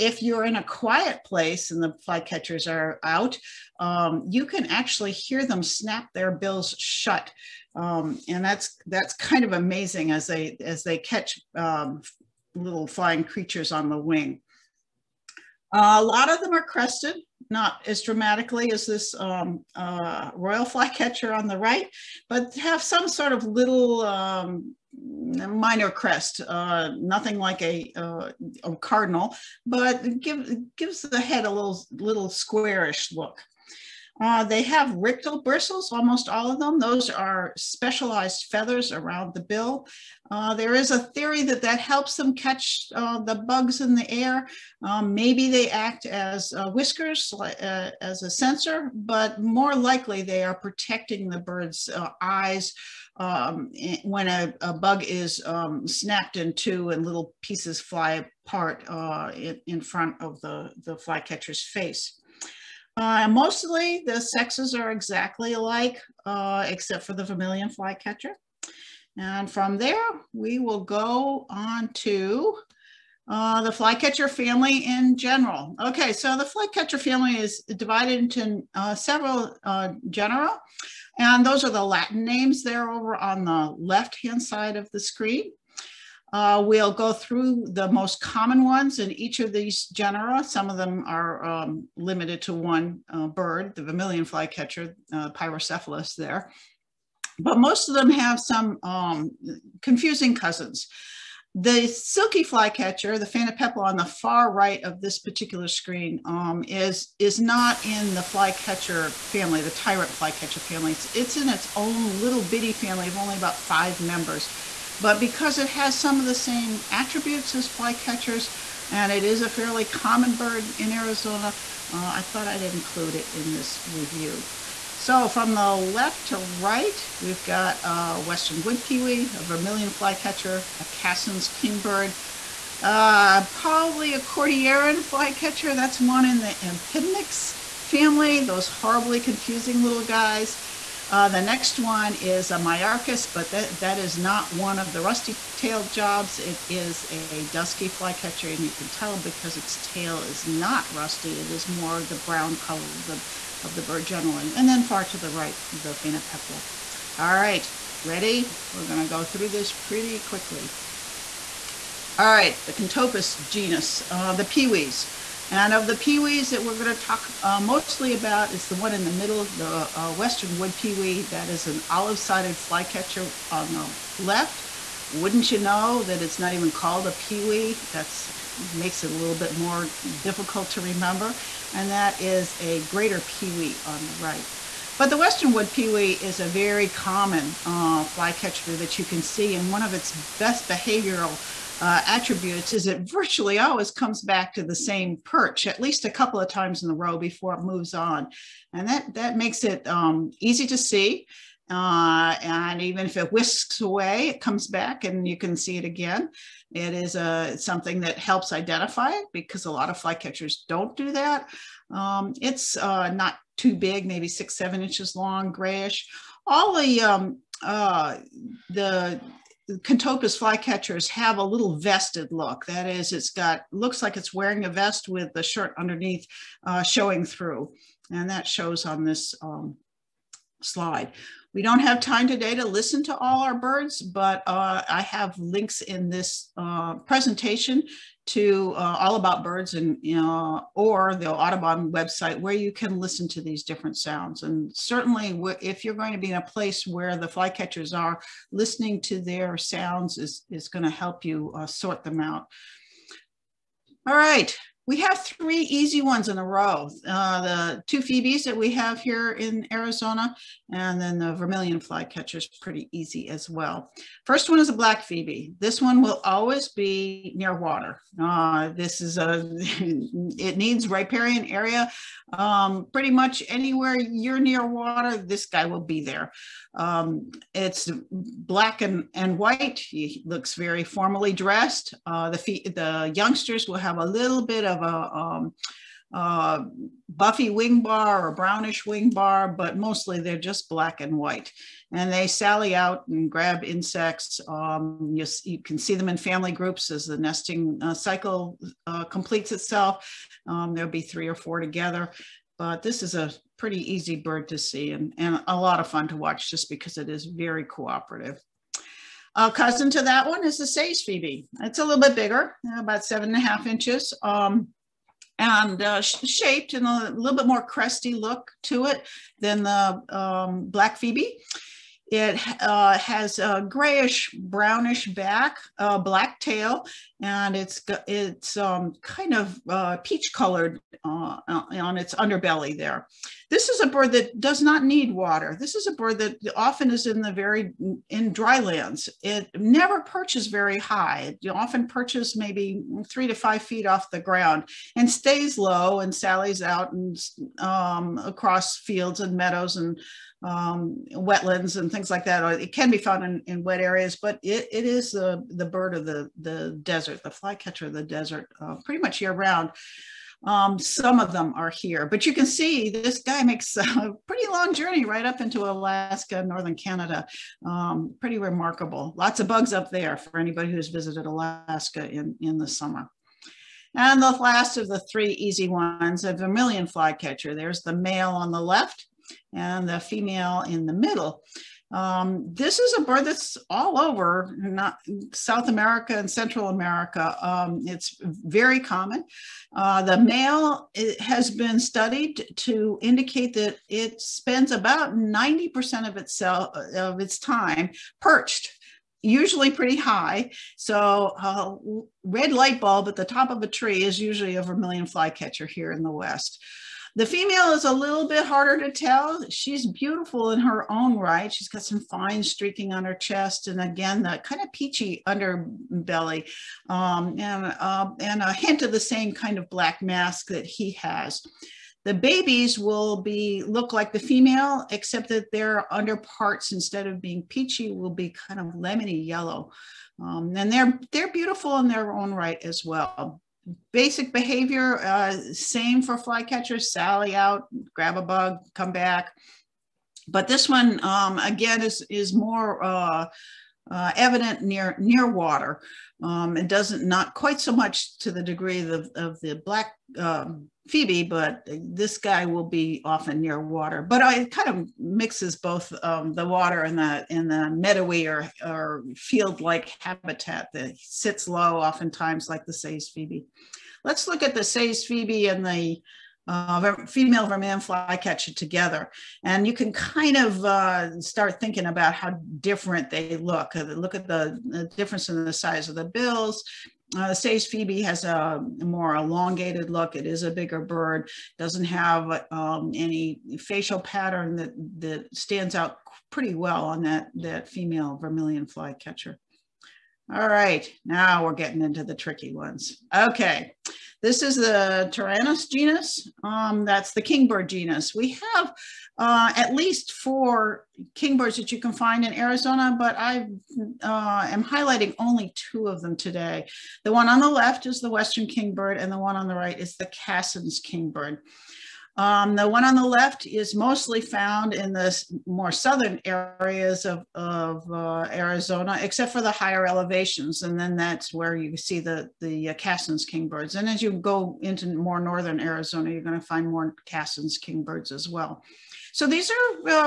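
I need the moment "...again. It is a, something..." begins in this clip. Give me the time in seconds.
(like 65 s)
205 s.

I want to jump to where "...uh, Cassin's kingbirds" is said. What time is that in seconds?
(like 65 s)
522 s.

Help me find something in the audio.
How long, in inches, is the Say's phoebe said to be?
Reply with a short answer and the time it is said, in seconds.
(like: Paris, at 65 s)
7.5 inches, at 313 s.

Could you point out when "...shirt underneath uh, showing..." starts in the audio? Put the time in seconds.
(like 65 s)
225 s.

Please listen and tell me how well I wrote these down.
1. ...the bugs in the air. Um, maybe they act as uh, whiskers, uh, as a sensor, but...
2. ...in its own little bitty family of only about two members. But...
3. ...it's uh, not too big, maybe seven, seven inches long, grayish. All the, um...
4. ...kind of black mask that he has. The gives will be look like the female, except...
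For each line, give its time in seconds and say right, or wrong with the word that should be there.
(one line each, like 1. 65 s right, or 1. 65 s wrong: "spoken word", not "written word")
1. 43 s right
2. 111 s wrong: "five", not "two"
3. 212 s wrong: "six", not "seven"
4. 419 s wrong: "babies", not "gives".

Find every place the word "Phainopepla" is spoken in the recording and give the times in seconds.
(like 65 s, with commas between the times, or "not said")
103 s, 155 s.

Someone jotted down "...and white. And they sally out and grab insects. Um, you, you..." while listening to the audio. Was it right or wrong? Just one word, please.
right.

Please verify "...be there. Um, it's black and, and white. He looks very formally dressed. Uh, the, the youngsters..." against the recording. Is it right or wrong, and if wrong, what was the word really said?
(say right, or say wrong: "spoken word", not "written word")
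right.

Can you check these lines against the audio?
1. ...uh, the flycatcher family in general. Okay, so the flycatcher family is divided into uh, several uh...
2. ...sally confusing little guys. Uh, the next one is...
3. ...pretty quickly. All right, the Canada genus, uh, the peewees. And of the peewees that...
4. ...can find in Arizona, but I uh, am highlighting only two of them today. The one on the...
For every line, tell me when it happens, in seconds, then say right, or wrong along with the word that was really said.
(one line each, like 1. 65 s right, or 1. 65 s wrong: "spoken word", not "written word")
1. 73 s right
2. 138 s wrong: "horribly", not "sally"
3. 159 s wrong: "Contopus", not "Canada"
4. 501 s right.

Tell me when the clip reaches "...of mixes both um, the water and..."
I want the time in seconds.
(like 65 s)
454 s.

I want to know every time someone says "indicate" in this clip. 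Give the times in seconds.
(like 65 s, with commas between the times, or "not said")
393 s.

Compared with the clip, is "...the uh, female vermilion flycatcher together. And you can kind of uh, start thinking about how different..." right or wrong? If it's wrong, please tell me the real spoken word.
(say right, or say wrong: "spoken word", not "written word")
right.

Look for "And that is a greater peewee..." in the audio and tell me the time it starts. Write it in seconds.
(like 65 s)
181 s.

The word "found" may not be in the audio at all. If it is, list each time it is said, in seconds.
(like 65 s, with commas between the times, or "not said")
352 s, 514 s.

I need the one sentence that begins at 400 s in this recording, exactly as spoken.
So uh, red light bulb at the top of a tree is usually a vermilion flycatcher here in the West.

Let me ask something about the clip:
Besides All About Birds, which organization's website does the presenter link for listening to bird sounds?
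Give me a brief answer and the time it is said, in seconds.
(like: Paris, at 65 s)
Audubon, at 241 s.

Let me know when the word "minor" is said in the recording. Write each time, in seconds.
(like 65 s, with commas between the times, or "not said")
25 s.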